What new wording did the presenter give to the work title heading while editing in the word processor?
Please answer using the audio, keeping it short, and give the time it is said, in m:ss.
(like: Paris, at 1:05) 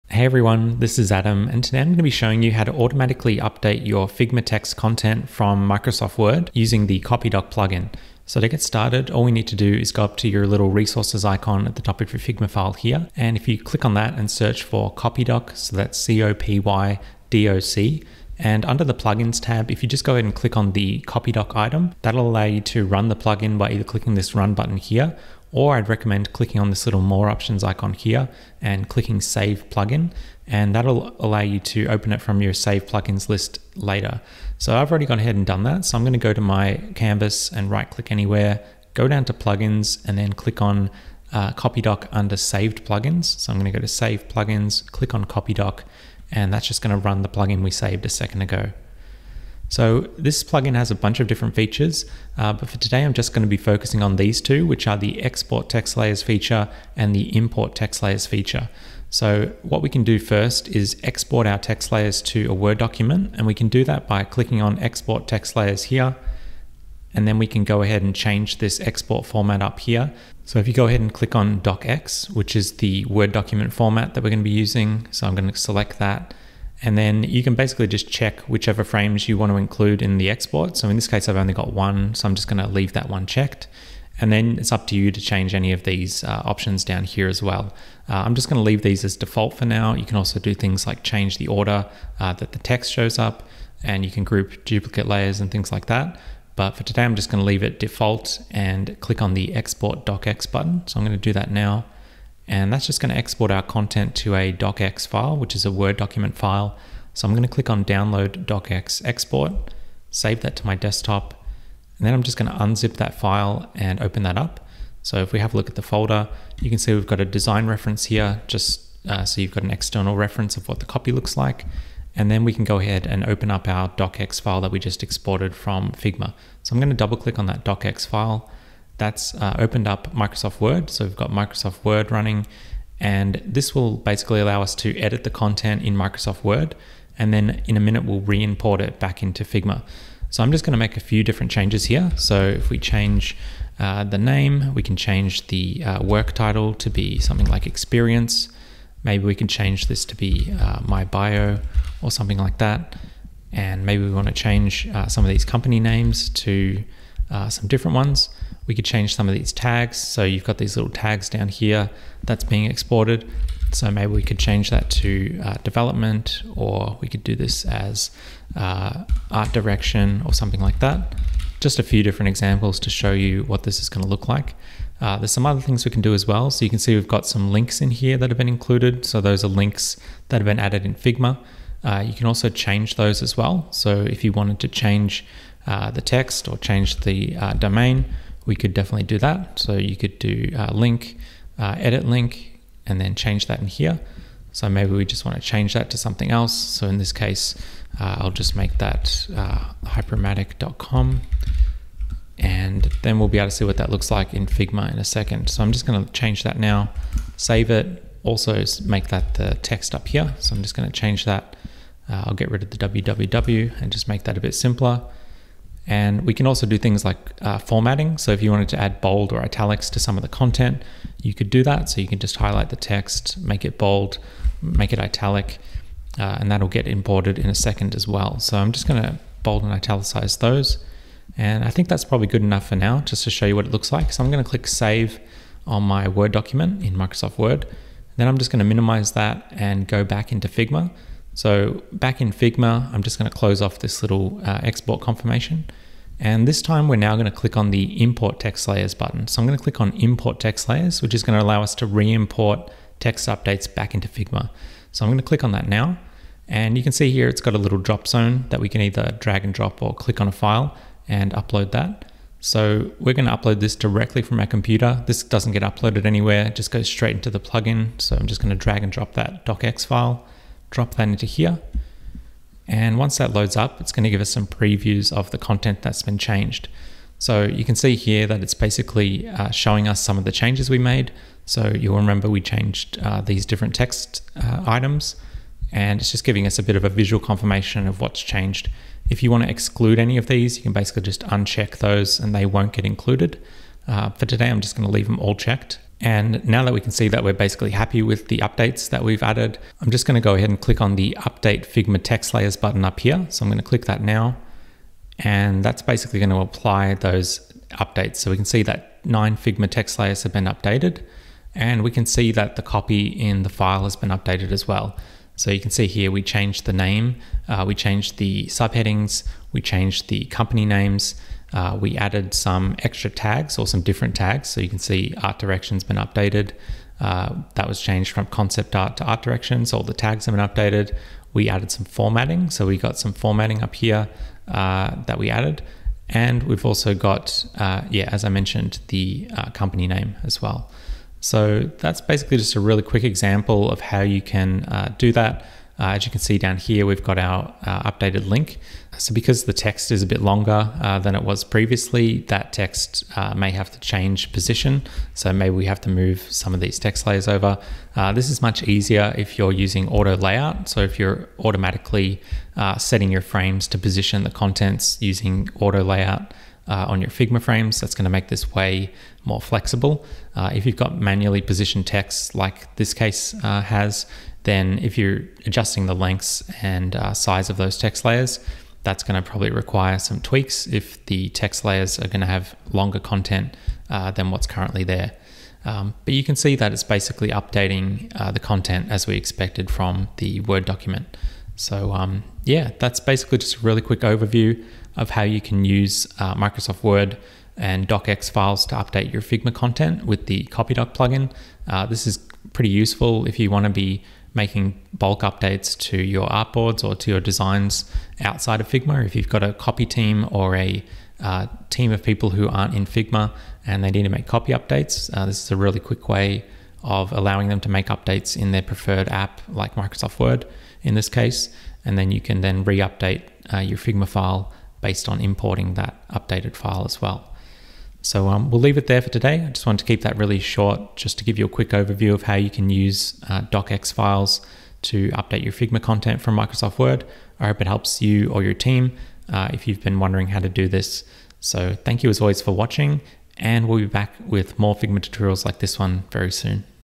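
experience, at 2:27.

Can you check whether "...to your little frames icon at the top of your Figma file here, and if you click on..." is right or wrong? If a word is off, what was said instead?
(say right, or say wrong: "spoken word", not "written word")
wrong: "resources", not "frames".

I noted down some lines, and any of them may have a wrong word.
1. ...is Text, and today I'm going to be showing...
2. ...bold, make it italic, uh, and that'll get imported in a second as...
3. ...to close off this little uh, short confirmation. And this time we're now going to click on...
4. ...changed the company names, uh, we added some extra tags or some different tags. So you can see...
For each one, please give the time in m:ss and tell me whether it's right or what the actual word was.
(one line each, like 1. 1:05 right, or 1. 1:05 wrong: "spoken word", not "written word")
1. 0:00 wrong: "Adam", not "Text"
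2. 3:43 right
3. 4:03 wrong: "export", not "short"
4. 5:19 right.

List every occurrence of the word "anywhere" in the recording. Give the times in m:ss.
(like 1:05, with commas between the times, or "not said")
0:38, 4:26.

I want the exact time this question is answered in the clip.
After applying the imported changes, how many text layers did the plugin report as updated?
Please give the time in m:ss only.
5:09.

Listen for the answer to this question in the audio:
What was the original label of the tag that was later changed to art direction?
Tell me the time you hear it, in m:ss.
5:28.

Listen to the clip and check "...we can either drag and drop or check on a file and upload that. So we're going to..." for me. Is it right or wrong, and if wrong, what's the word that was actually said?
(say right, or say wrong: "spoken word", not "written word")
wrong: "click", not "check".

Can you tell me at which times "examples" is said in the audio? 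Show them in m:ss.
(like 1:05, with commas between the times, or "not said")
2:52, 5:43.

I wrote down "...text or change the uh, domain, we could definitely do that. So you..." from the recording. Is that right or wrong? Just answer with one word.
right.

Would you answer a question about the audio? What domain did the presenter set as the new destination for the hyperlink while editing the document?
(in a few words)
hypermatic.com.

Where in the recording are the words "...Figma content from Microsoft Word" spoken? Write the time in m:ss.
7:15.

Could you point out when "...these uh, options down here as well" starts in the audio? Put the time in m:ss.
1:25.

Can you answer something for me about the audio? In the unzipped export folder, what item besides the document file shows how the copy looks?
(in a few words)
design reference.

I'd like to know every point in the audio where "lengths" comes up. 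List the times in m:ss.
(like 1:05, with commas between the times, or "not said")
6:15.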